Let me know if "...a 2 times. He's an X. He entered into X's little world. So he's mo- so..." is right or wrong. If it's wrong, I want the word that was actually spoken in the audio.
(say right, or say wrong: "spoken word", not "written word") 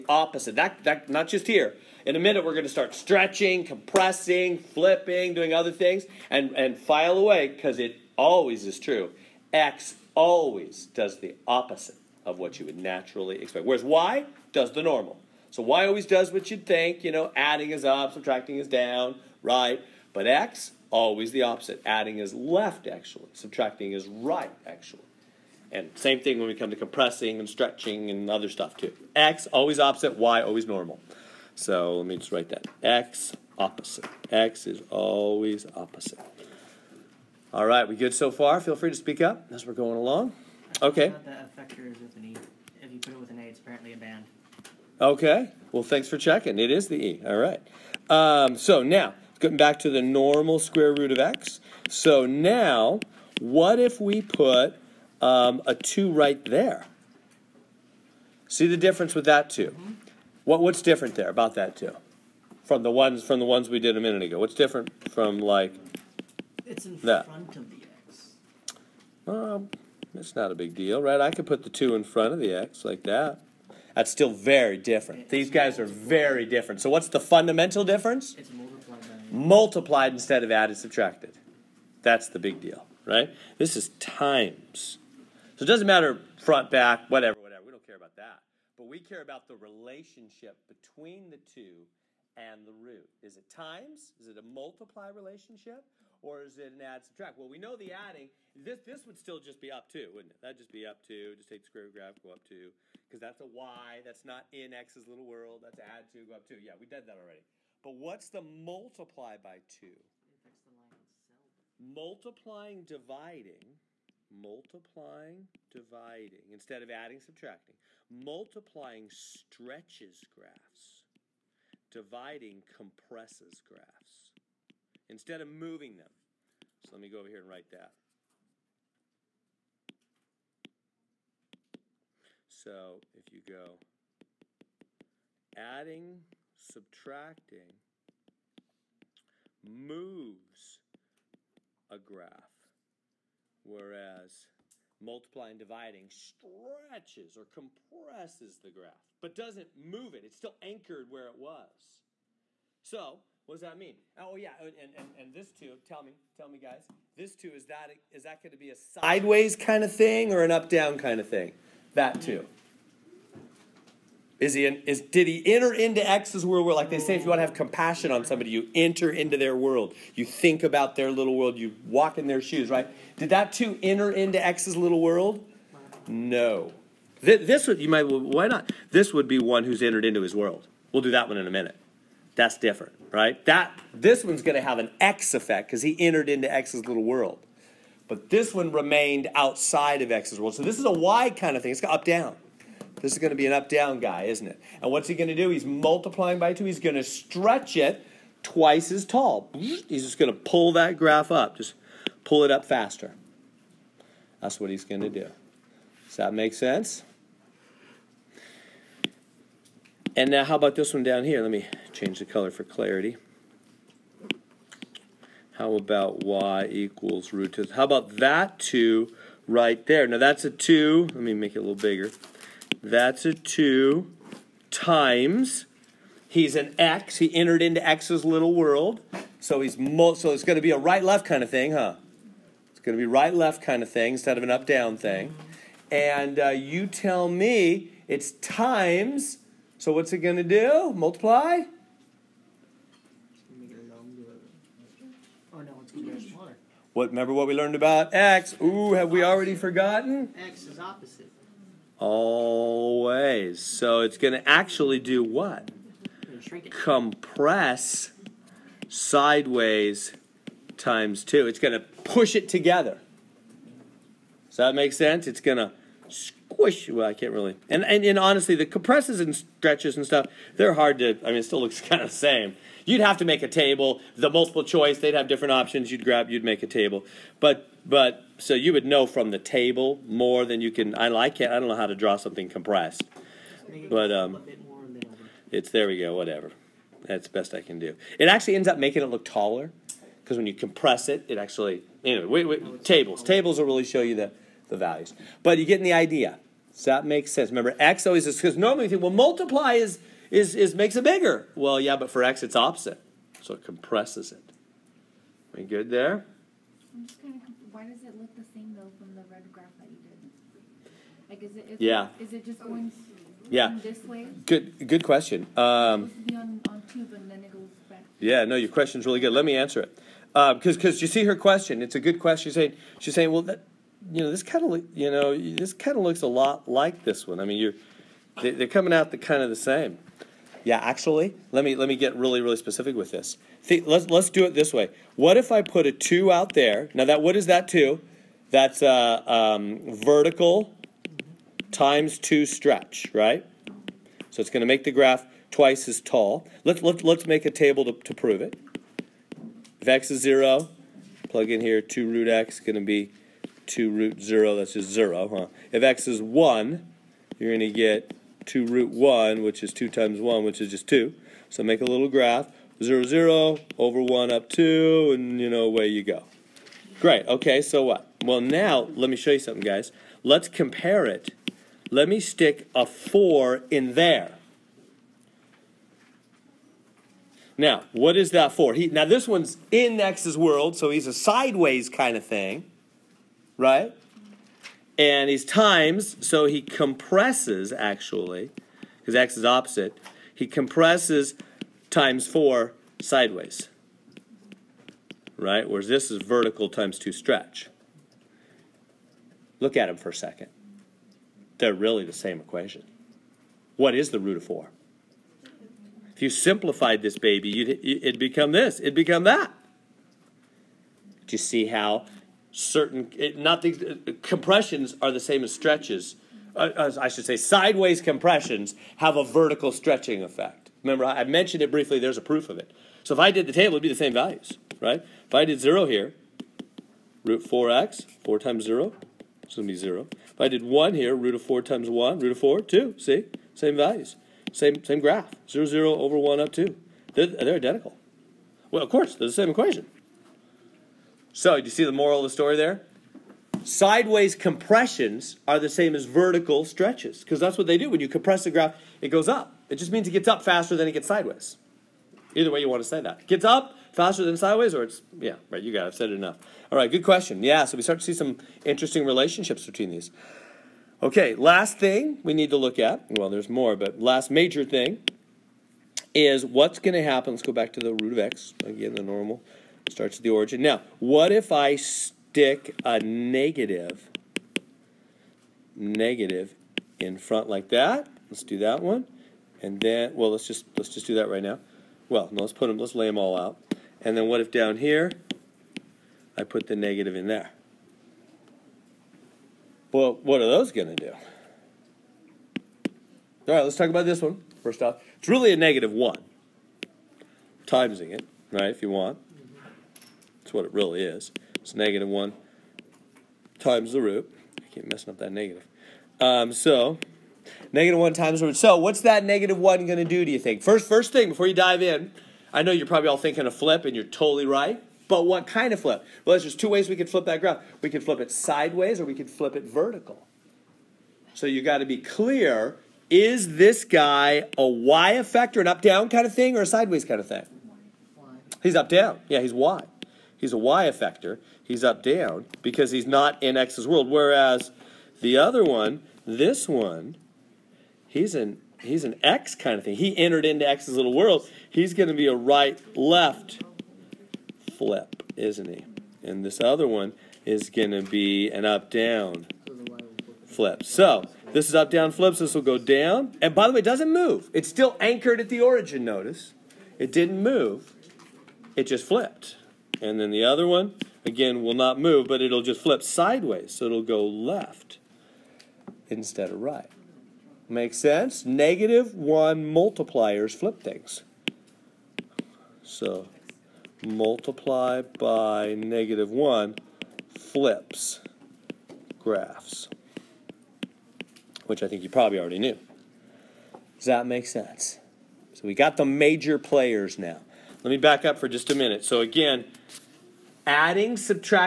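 right.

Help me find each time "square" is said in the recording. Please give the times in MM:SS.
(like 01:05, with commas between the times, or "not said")
00:50, 01:41.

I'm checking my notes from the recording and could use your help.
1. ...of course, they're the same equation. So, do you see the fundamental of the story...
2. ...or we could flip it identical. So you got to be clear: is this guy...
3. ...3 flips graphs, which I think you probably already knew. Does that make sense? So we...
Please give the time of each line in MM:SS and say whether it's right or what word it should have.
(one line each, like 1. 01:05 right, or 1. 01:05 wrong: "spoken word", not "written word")
1. 07:18 wrong: "moral", not "fundamental"
2. 08:39 wrong: "vertical", not "identical"
3. 09:36 wrong: "1", not "3".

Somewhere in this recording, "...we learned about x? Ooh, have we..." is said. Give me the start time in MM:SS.
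04:07.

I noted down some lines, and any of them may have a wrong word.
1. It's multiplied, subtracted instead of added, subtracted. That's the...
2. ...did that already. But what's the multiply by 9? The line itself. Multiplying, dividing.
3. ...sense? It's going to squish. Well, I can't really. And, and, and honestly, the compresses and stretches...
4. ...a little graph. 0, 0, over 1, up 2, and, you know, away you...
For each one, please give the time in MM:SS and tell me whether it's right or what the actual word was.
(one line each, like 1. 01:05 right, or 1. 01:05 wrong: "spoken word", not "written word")
1. 01:18 wrong: "multiplied", not "subtracted"
2. 01:46 wrong: "2", not "9"
3. 04:24 right
4. 06:01 right.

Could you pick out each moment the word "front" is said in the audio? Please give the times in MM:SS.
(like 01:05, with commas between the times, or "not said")
01:07, 01:12, 01:26, 07:57.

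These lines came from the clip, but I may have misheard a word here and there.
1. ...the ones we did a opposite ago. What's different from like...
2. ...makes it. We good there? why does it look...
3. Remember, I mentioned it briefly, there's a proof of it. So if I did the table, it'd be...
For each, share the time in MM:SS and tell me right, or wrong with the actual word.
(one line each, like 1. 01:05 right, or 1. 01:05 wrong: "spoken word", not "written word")
1. 01:03 wrong: "minute", not "opposite"
2. 05:03 wrong: "compresses", not "makes"
3. 07:00 right.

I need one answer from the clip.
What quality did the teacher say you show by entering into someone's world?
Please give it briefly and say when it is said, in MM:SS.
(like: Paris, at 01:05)
compassion, at 02:47.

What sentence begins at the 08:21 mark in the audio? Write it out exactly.
It's negative 1 times the root.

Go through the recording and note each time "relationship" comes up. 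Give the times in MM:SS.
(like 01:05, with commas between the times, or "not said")
01:29, 01:35, 07:39.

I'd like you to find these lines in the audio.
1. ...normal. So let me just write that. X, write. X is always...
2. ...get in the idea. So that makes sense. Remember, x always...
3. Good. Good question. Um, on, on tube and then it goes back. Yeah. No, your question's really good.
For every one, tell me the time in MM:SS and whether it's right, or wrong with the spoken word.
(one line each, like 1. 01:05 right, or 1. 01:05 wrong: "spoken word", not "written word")
1. 00:30 wrong: "opposite", not "write"
2. 04:55 right
3. 05:14 right.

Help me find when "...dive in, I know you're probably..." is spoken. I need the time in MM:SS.
08:31.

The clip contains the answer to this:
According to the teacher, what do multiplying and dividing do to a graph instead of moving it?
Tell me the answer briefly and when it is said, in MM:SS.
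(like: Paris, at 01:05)
stretches or compresses, at 02:26.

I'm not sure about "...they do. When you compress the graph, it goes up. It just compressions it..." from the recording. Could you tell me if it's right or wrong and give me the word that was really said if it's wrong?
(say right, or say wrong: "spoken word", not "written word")
wrong: "means", not "compressions".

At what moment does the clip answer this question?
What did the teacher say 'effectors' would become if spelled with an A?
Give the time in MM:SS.
00:43.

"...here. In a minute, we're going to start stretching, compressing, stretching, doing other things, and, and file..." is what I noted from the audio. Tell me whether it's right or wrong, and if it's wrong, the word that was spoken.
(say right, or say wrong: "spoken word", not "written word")
wrong: "flipping", not "stretching".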